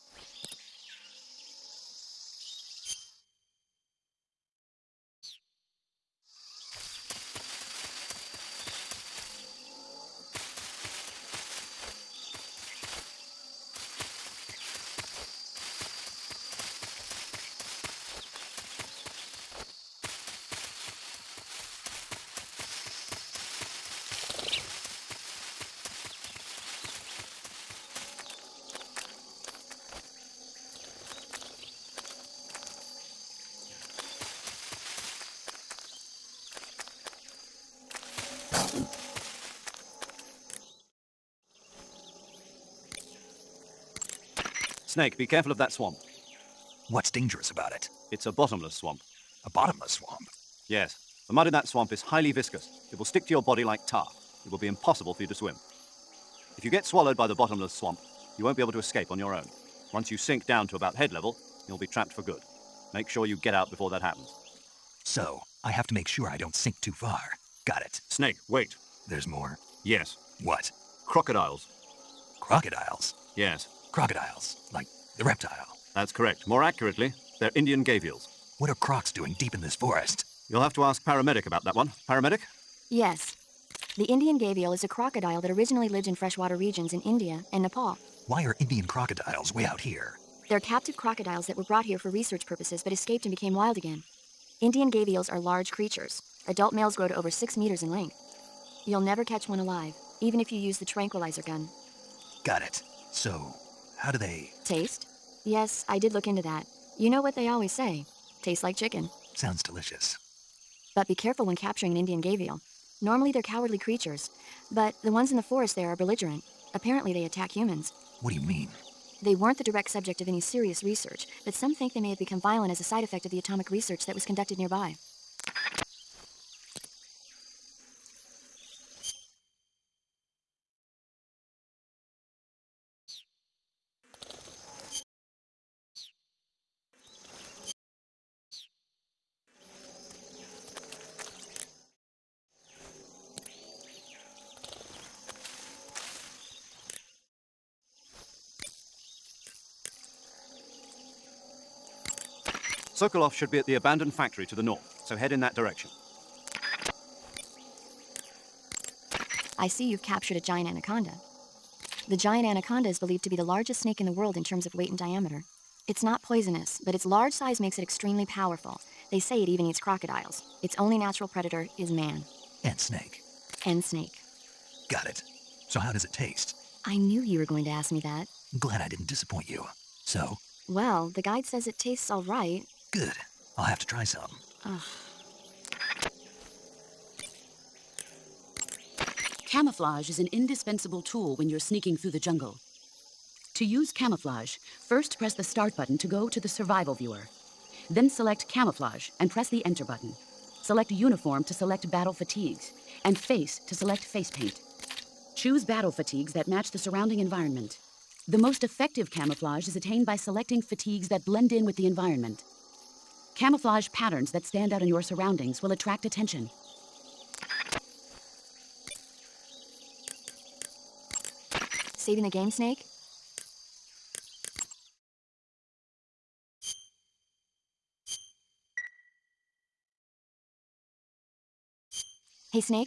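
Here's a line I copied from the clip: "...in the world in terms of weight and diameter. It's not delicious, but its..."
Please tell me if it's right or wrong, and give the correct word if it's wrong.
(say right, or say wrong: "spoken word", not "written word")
wrong: "poisonous", not "delicious".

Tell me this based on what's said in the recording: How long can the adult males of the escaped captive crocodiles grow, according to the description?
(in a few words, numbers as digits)
over 6 meters.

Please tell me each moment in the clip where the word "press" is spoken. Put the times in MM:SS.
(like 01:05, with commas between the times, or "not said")
03:15, 03:19.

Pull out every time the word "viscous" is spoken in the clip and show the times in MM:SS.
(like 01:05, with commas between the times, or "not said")
00:52.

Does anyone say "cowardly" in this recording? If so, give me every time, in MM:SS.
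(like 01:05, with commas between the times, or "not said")
01:53.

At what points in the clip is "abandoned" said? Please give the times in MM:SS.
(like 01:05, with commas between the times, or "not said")
02:33.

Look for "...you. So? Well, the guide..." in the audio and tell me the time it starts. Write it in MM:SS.
02:59.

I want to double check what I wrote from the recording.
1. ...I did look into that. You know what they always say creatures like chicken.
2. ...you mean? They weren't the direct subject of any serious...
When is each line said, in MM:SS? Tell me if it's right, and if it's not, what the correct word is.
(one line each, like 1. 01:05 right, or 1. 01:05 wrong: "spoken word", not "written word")
1. 01:45 wrong: "tastes", not "creatures"
2. 01:58 right.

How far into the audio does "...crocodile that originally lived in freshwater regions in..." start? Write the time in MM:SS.
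01:24.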